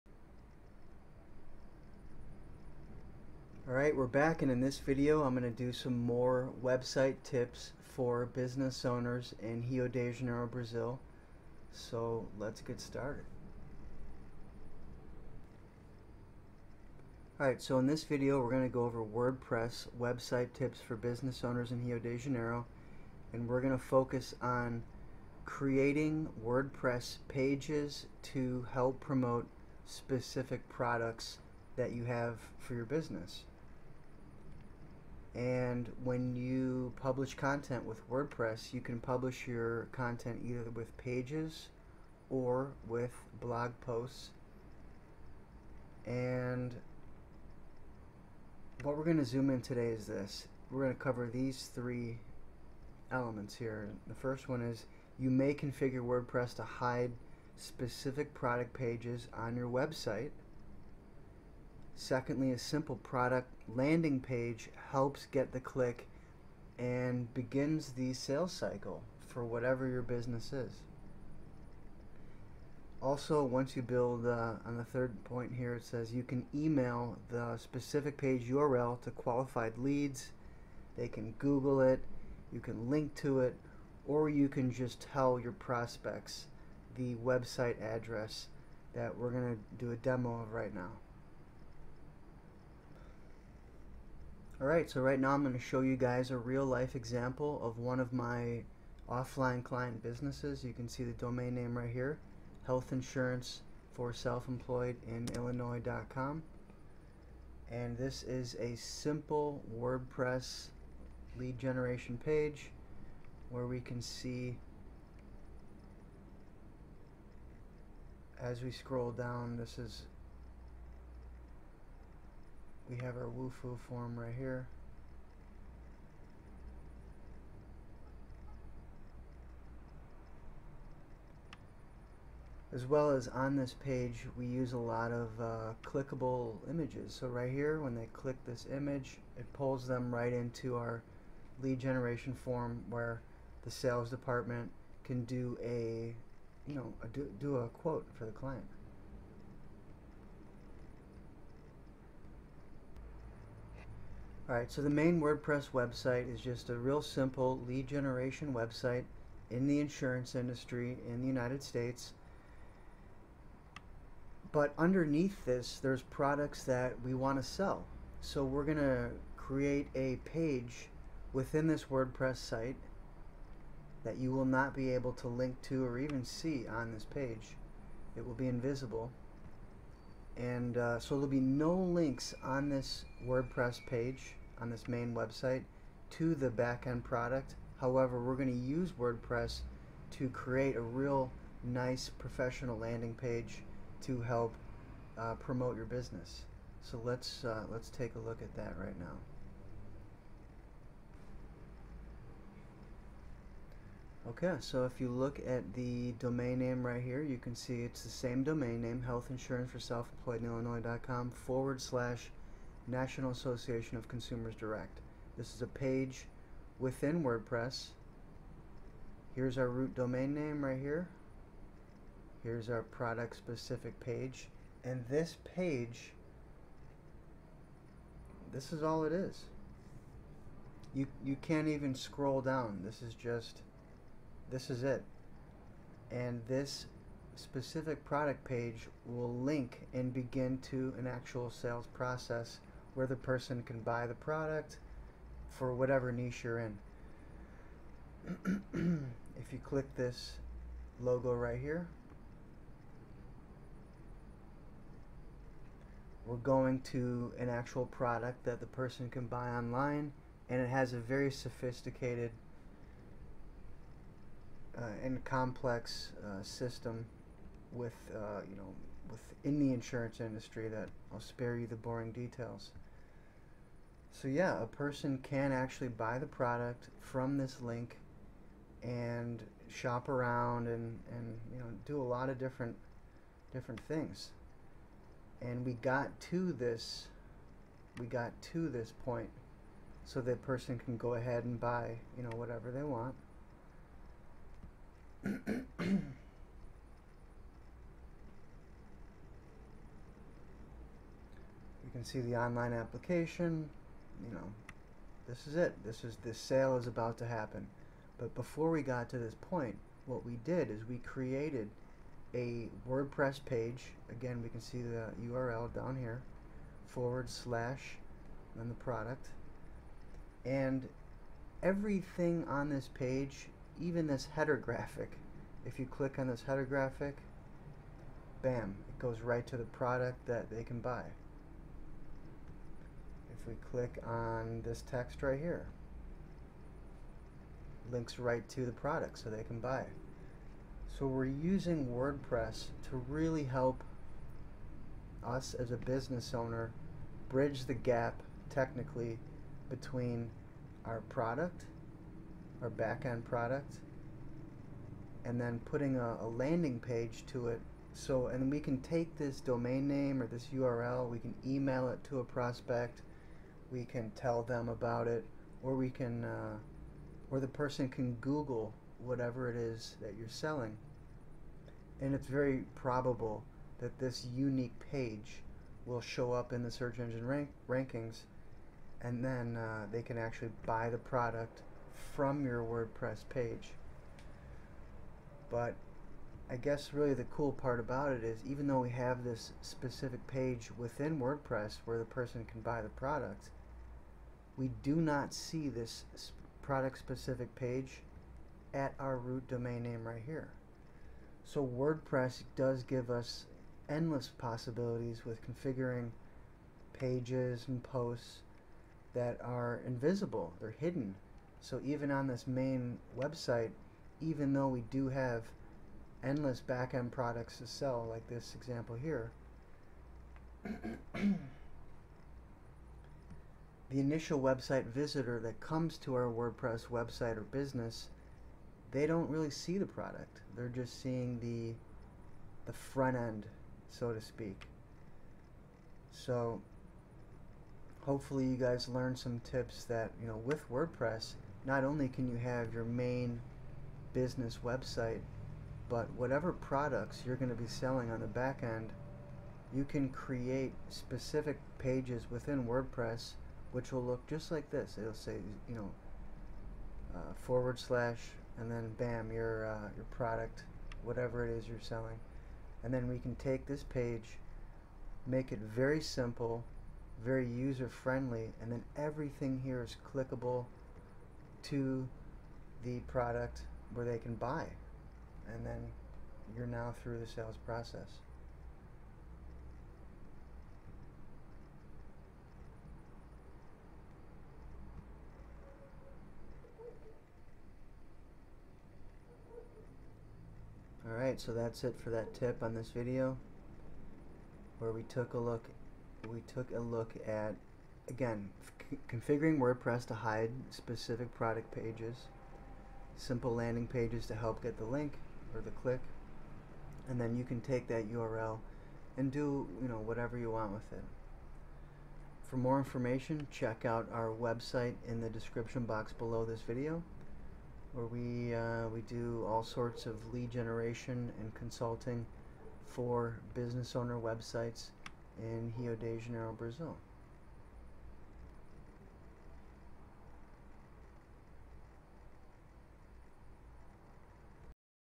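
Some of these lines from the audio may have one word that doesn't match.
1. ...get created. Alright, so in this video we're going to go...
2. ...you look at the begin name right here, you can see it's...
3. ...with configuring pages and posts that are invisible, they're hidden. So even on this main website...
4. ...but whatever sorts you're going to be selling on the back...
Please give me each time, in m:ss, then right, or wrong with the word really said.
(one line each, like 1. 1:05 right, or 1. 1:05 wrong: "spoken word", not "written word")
1. 0:12 wrong: "started", not "created"
2. 3:25 wrong: "domain", not "begin"
3. 6:45 right
4. 7:25 wrong: "products", not "sorts".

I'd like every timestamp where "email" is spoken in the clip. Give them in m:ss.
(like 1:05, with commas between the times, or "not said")
1:16, 6:01.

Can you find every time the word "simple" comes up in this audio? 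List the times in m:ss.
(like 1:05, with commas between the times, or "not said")
1:02, 1:48, 2:37, 7:46, 8:23.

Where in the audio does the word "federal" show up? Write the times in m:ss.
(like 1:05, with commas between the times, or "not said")
not said.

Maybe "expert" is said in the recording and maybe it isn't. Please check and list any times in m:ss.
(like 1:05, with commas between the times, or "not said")
not said.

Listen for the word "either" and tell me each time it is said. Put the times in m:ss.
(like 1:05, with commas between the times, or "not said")
0:40.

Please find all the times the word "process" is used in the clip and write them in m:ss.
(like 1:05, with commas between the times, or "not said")
4:01, 7:57.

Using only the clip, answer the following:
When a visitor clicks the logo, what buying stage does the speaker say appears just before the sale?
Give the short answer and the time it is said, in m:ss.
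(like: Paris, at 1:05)
online application, at 5:02.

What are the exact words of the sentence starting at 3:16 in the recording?
So let's uh, let's take a look at that right now.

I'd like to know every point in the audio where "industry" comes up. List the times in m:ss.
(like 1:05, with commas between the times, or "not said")
2:40, 4:30.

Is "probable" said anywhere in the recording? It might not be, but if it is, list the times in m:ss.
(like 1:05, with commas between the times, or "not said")
6:12.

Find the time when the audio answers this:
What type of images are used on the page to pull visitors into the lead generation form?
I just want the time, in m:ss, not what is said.
2:15.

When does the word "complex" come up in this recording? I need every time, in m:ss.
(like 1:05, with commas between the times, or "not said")
4:25.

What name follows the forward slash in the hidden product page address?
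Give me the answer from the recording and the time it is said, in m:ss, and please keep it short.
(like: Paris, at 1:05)
National Association of Consumers Direct, at 3:32.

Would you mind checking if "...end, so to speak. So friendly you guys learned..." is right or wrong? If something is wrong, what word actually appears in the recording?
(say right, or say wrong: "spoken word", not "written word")
wrong: "hopefully", not "friendly".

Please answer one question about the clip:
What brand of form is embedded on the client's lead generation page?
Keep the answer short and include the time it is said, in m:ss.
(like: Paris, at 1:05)
Wufoo, at 2:03.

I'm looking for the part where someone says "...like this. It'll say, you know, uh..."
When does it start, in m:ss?
7:34.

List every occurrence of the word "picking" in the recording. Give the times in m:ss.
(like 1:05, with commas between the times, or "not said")
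not said.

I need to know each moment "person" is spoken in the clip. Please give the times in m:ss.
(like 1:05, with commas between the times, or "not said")
4:03, 4:18, 4:34, 4:50, 6:07, 6:32.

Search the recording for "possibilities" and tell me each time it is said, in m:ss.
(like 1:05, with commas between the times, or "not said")
6:44.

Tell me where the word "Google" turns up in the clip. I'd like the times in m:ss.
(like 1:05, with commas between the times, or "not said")
1:21, 6:08.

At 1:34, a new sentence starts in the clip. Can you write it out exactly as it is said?
Alright, so right now I'm going to show you guys a real life example of one of my offline client businesses.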